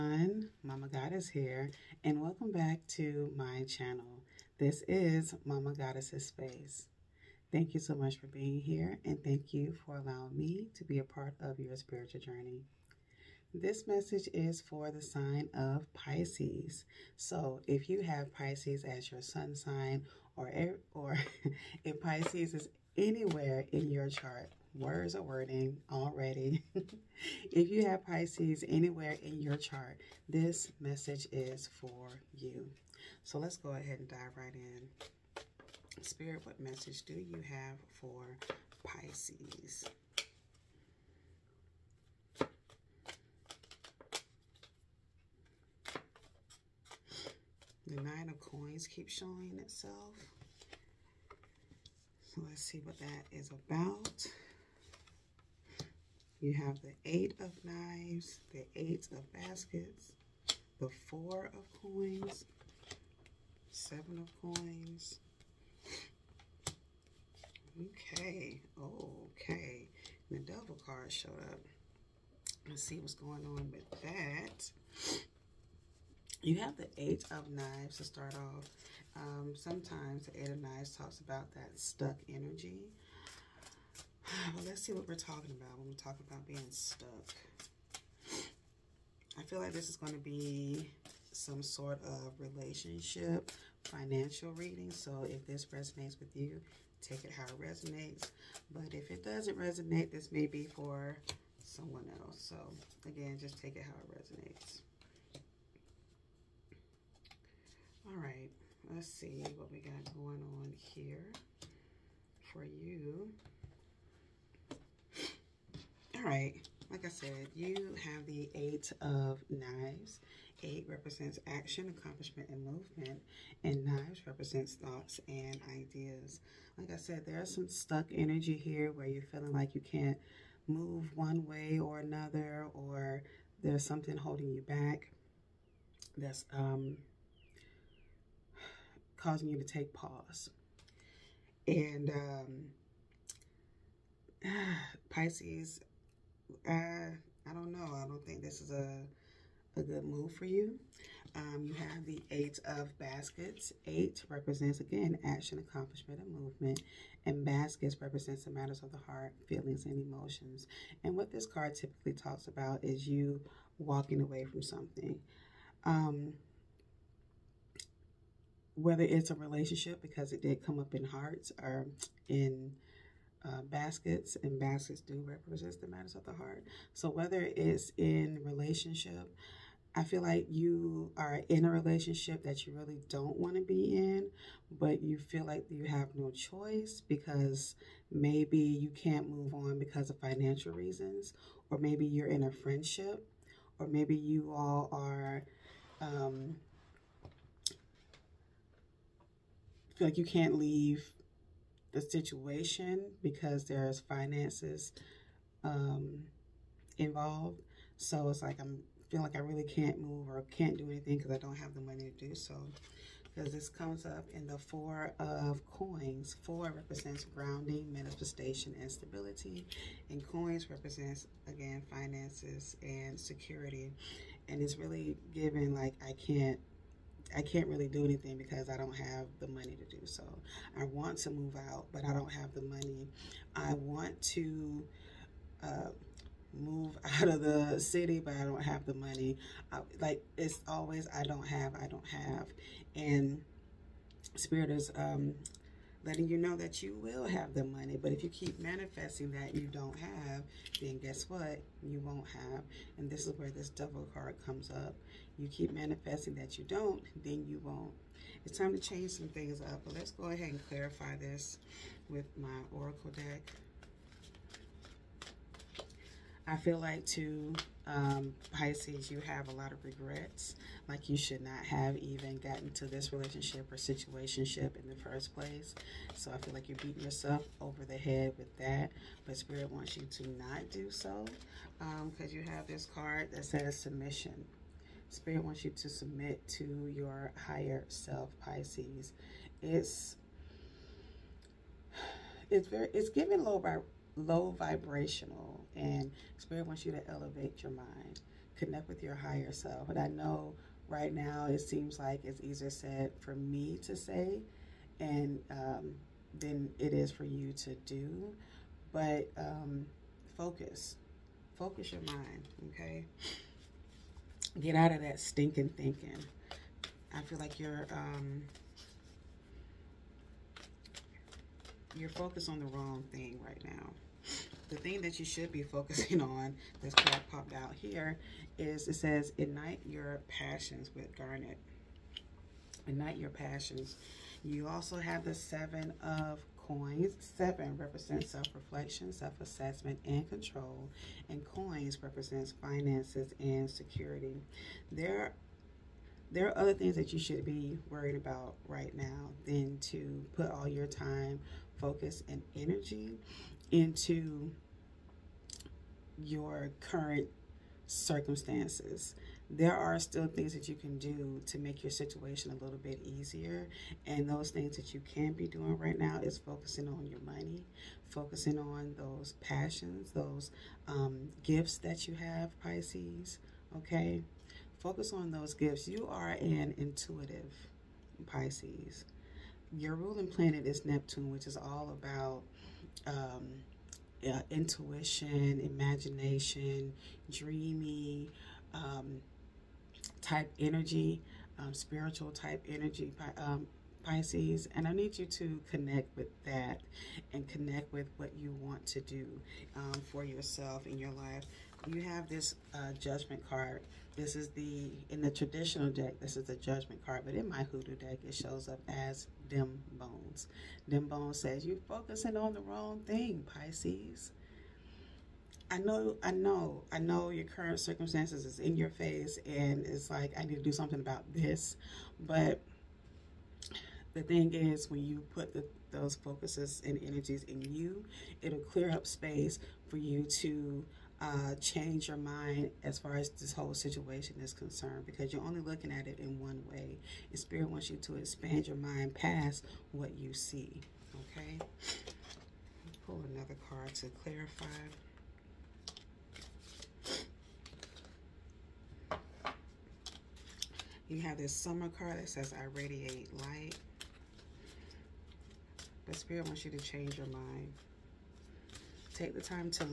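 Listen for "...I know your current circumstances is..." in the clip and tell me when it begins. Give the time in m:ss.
6:56.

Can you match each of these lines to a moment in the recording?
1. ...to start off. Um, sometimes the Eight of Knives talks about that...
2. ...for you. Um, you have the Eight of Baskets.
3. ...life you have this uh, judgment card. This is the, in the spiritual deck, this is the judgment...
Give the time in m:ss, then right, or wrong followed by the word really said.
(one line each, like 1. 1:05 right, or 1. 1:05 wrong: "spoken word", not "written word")
1. 1:17 right
2. 2:30 right
3. 6:41 wrong: "traditional", not "spiritual".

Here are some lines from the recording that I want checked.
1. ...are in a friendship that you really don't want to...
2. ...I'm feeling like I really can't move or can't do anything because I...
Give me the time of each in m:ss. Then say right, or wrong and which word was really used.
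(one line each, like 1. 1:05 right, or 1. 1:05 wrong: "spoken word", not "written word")
1. 3:01 wrong: "relationship", not "friendship"
2. 3:28 right.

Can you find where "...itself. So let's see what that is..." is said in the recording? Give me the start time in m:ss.
0:49.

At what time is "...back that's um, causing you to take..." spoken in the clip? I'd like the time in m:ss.
2:14.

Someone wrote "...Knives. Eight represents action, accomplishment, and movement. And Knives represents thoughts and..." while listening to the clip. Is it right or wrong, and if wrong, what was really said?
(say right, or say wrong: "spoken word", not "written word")
right.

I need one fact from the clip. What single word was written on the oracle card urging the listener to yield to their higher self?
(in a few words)
Submission.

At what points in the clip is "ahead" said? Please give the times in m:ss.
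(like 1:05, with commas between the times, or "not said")
0:33, 4:20.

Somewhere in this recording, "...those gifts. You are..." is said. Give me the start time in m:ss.
6:15.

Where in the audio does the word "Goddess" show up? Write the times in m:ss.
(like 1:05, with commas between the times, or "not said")
0:00, 0:05.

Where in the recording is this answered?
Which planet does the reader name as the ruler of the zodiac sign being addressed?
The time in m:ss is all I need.
6:20.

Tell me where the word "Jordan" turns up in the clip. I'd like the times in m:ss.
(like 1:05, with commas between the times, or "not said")
not said.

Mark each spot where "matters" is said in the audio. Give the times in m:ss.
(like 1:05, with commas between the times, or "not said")
2:38, 2:55.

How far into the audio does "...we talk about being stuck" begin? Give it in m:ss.
1:25.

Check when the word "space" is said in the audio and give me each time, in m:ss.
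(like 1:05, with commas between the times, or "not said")
0:06, 7:09.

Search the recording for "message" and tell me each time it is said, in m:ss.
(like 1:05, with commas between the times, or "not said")
0:13, 0:30, 0:36.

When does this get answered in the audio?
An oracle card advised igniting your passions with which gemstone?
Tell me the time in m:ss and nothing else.
5:31.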